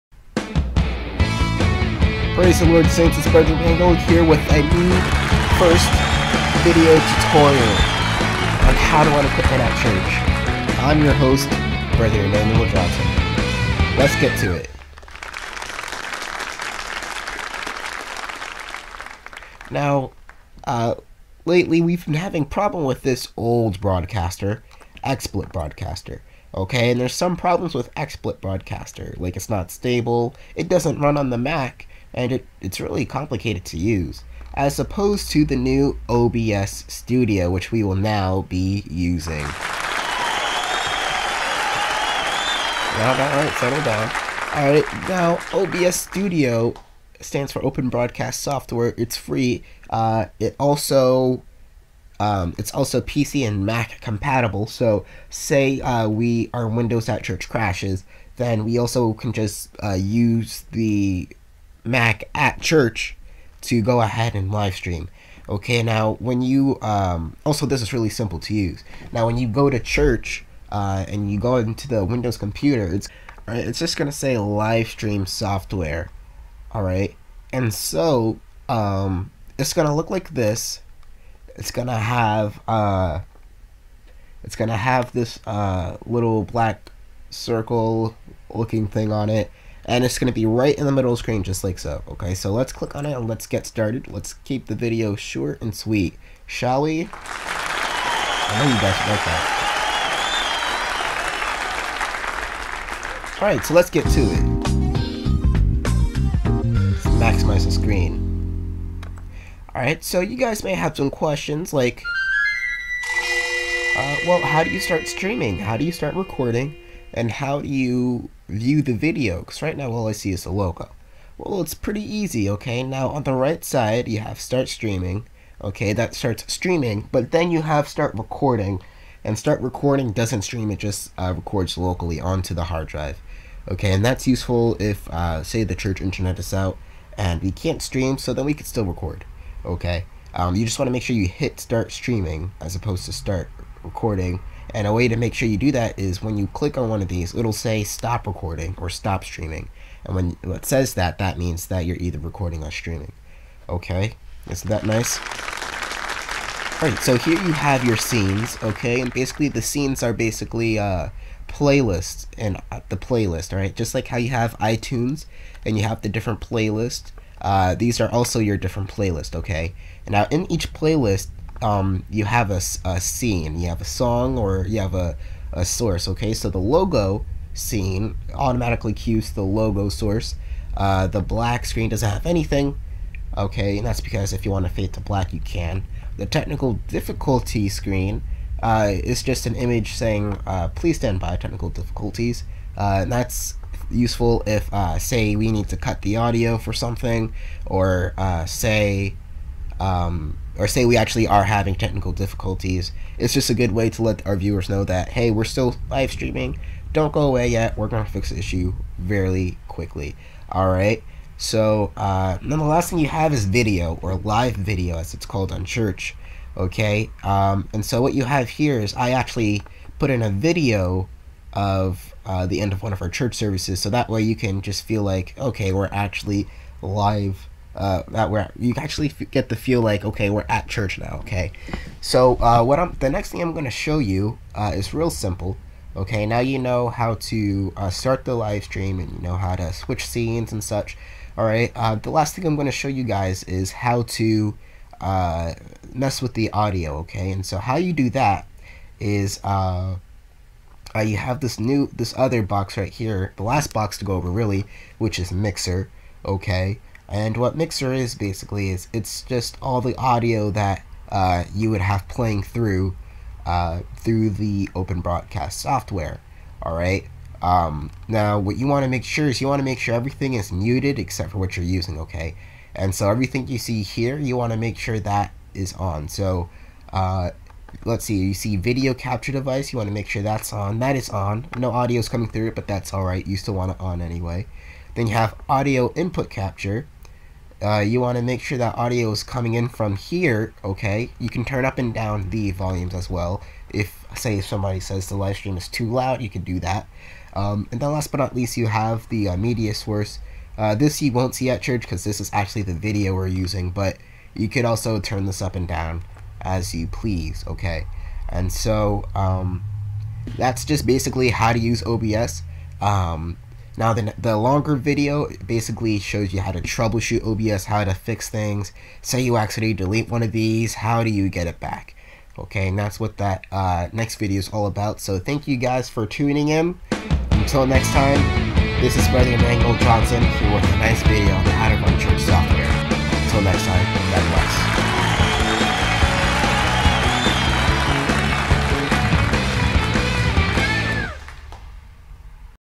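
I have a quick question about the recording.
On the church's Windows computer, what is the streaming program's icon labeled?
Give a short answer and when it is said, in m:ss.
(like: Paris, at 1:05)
live stream software, at 1:14.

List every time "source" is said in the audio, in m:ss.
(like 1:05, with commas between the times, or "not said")
2:55, 2:59, 4:59.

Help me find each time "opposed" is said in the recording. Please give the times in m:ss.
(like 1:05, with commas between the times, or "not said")
0:34, 2:22.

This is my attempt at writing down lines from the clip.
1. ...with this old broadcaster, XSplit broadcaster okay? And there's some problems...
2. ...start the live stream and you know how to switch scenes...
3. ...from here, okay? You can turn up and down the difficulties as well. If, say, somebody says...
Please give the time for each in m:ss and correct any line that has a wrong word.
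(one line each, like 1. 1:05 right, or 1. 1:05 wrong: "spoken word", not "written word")
1. 0:22 right
2. 3:57 right
3. 4:49 wrong: "volumes", not "difficulties".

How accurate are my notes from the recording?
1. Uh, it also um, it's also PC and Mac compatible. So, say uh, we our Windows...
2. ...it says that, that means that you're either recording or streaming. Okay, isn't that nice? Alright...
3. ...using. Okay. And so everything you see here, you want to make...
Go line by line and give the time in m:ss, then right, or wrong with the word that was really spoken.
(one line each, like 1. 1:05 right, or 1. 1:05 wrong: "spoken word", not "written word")
1. 0:49 right
2. 2:30 right
3. 4:31 right.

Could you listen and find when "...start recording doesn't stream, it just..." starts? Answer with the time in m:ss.
2:09.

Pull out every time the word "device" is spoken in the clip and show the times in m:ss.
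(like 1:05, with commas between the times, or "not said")
4:39.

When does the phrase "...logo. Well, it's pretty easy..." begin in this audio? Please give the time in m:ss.
2:00.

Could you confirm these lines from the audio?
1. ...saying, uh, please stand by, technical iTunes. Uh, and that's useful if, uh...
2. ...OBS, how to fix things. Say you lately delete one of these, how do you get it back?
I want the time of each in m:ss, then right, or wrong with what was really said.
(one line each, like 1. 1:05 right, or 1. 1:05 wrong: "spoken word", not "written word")
1. 3:09 wrong: "difficulties", not "iTunes"
2. 5:17 wrong: "accidentally", not "lately".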